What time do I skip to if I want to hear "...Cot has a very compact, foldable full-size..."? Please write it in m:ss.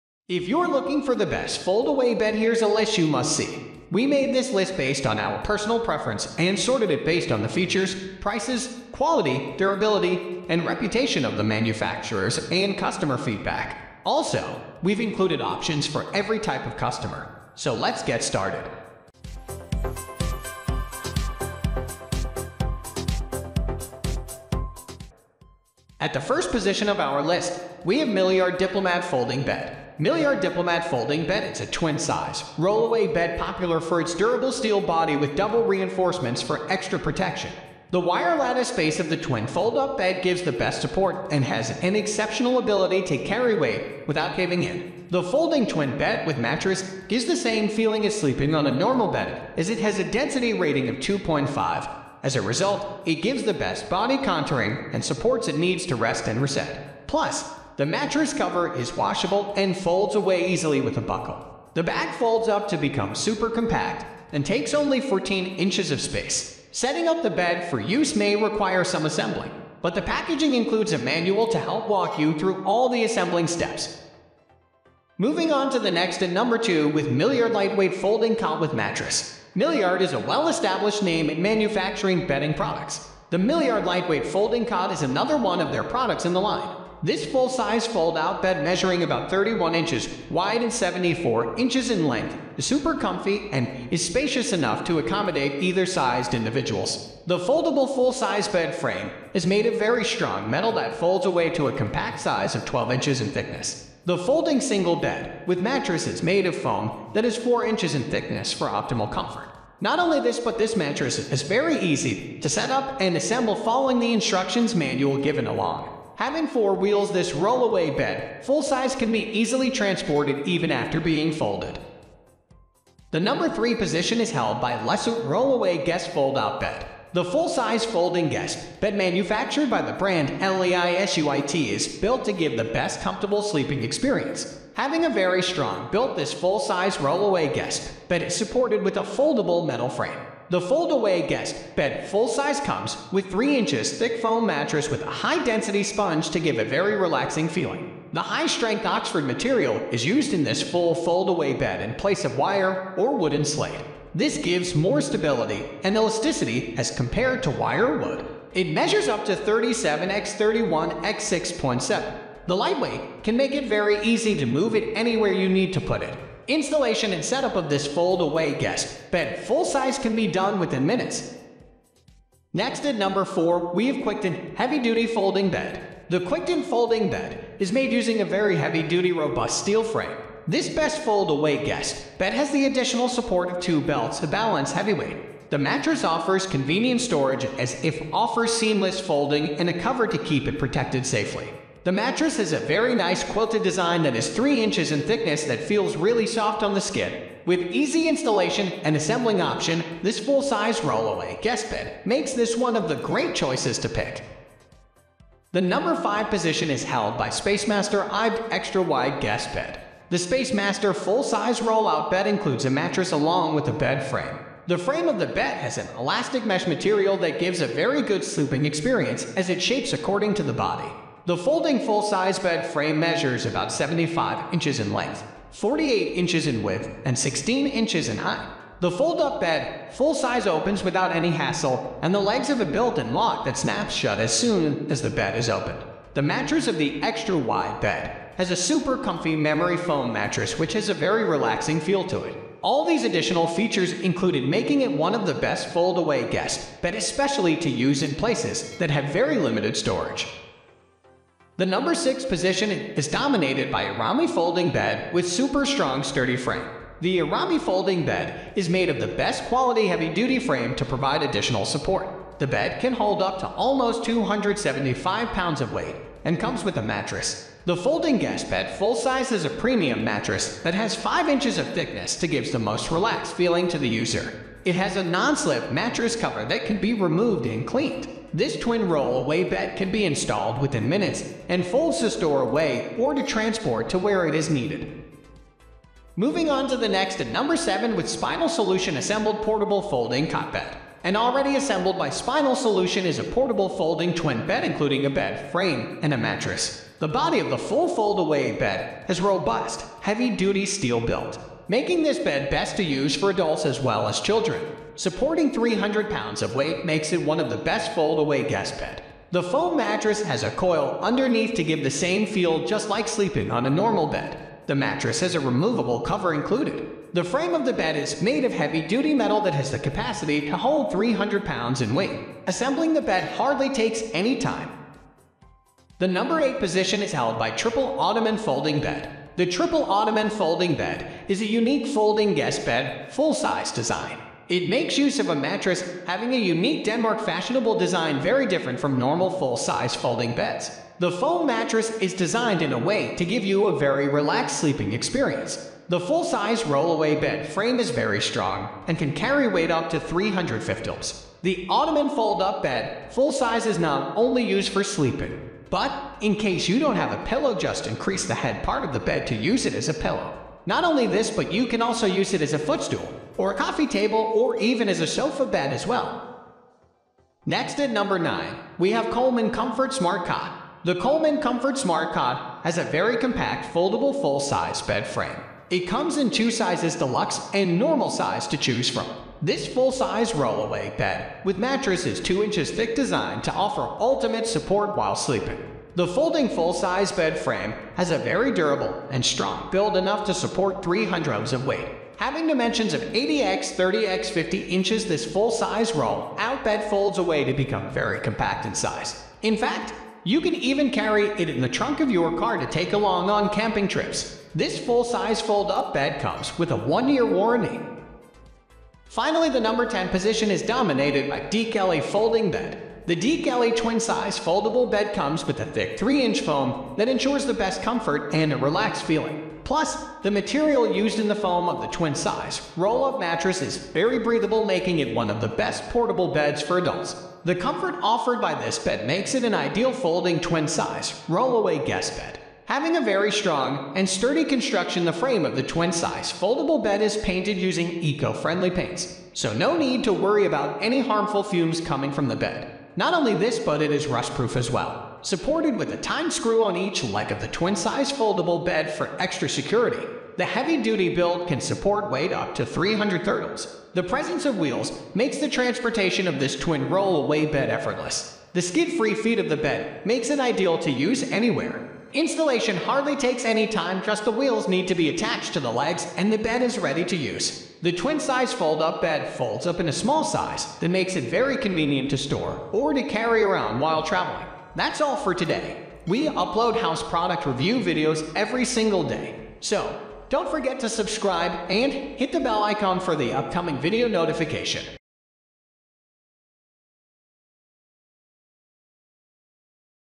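6:12.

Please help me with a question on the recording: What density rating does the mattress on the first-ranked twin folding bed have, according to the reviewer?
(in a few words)
2.5.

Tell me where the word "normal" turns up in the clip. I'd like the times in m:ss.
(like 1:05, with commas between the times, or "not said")
0:48, 5:13, 5:38, 6:17.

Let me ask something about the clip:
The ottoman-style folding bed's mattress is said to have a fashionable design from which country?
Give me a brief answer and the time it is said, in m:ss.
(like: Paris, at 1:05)
Denmark, at 5:36.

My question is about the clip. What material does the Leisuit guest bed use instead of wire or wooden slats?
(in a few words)
Oxford material.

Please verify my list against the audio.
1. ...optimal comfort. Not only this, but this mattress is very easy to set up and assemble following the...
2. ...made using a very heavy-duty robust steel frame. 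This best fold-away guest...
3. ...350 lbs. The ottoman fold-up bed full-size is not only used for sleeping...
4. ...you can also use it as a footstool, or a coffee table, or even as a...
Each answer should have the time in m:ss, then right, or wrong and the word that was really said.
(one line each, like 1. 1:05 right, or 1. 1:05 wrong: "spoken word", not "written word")
1. 1:48 right
2. 2:57 right
3. 5:50 right
4. 6:01 right.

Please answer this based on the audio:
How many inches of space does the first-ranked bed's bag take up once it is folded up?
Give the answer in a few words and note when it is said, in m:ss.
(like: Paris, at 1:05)
14 inches, at 1:05.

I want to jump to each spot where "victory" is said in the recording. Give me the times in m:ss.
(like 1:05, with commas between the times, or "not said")
not said.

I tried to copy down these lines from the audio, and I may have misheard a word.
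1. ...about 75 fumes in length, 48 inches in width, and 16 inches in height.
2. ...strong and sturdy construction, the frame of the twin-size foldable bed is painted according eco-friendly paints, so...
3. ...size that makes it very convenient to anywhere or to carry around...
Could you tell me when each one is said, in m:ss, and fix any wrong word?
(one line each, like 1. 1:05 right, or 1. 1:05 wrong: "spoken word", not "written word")
1. 3:43 wrong: "inches", not "fumes"
2. 7:13 wrong: "using", not "according"
3. 7:50 wrong: "store", not "anywhere".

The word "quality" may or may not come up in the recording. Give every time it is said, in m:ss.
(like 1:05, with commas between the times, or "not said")
0:08, 4:19.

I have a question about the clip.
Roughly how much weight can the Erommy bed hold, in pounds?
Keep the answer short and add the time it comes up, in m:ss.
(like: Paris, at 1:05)
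275 pounds, at 4:24.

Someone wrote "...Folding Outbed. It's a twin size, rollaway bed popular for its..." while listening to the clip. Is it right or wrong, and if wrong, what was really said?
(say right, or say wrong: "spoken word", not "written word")
wrong: "Bed", not "Outbed".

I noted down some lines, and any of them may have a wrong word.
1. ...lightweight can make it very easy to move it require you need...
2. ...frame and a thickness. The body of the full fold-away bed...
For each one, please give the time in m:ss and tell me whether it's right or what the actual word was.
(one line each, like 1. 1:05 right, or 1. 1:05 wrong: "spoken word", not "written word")
1. 2:42 wrong: "anywhere", not "require"
2. 4:55 wrong: "mattress", not "thickness".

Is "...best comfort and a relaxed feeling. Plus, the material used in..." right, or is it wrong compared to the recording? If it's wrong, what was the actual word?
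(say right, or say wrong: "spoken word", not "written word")
right.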